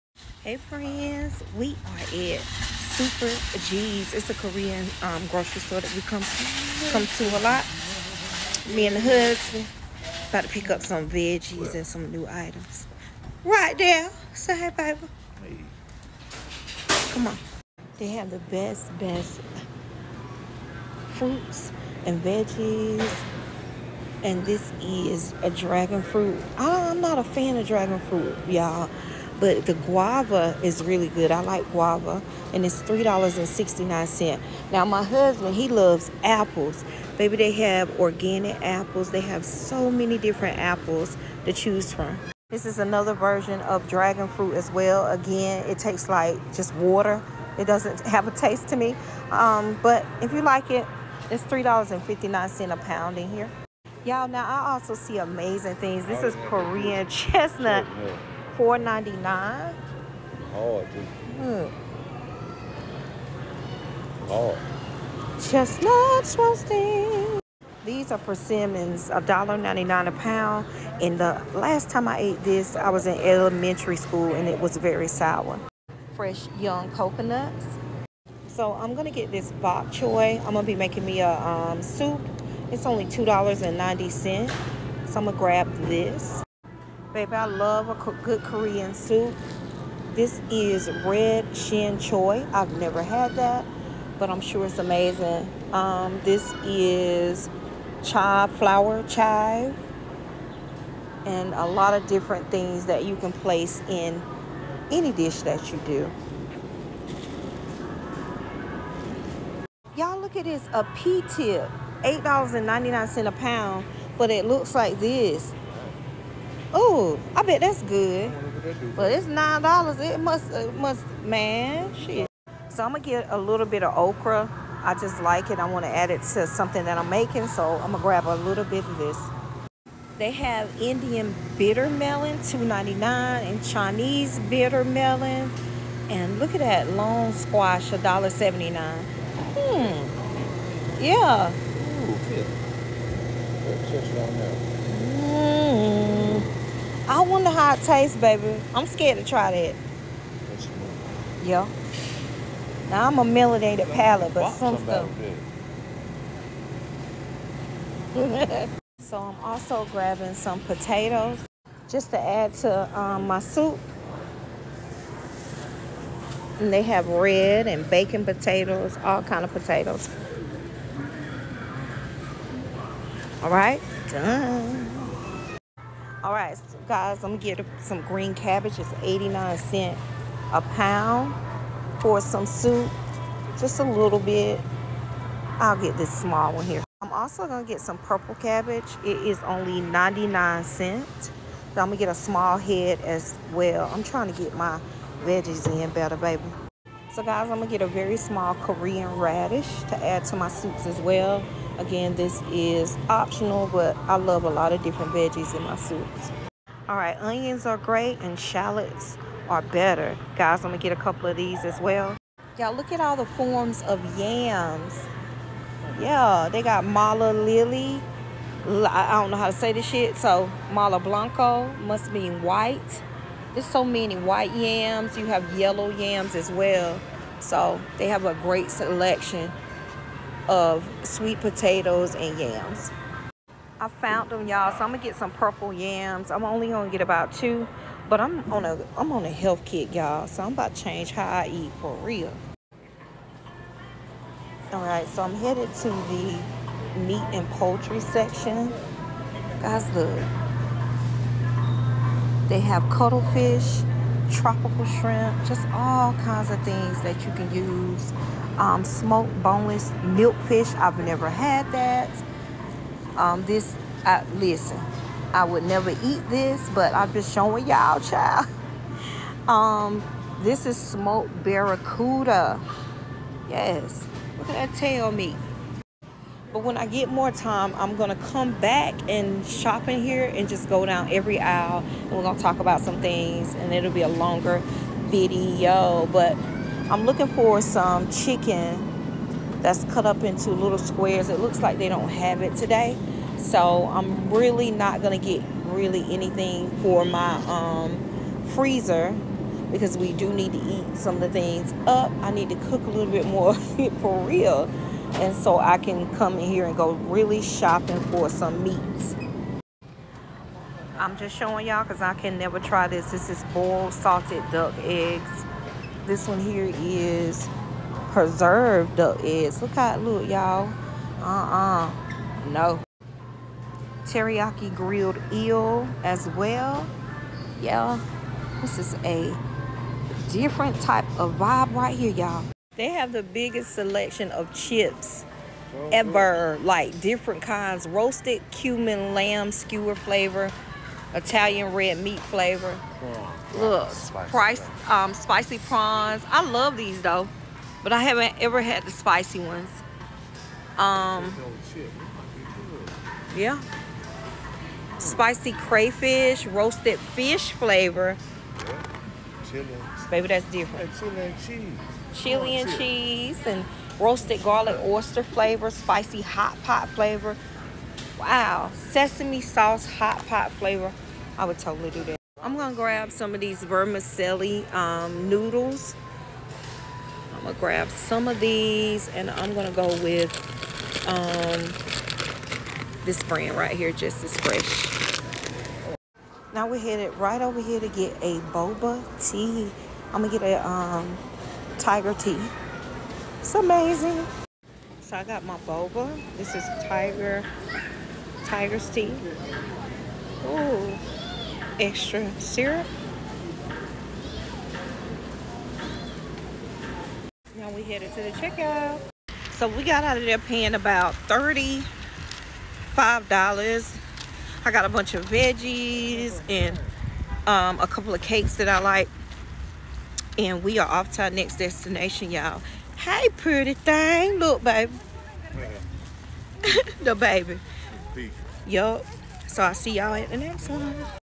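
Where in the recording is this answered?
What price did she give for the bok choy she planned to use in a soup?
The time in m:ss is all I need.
1:23.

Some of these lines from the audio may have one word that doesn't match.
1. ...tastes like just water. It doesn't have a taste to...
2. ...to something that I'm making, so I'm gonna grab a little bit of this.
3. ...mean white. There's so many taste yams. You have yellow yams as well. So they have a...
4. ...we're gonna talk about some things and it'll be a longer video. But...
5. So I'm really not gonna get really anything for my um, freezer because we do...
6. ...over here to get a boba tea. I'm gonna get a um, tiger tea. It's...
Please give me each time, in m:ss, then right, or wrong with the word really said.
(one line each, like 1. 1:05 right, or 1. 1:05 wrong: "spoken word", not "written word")
1. 0:45 right
2. 2:06 right
3. 3:42 wrong: "white", not "taste"
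4. 4:42 right
5. 4:53 right
6. 6:27 right.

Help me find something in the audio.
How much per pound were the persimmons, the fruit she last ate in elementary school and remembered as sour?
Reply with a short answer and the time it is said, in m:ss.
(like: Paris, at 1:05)
$1.99, at 1:09.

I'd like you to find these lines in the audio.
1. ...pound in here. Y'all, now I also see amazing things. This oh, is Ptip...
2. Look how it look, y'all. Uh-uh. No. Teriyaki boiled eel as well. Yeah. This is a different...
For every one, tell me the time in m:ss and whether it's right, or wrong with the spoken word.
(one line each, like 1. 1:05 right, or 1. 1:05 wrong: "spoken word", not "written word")
1. 0:52 wrong: "Korean", not "Ptip"
2. 5:19 wrong: "grilled", not "boiled".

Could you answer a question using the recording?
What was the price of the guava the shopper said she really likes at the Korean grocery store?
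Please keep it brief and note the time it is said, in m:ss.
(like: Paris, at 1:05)
$3.69, at 0:32.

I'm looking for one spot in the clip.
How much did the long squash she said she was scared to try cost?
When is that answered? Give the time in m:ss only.
2:17.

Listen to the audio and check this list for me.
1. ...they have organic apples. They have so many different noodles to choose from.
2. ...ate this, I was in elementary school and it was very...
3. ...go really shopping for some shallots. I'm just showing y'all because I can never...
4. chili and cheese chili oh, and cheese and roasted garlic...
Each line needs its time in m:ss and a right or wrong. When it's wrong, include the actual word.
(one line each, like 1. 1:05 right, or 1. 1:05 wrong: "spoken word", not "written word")
1. 0:37 wrong: "apples", not "noodles"
2. 1:12 right
3. 5:06 wrong: "meats", not "shallots"
4. 6:00 right.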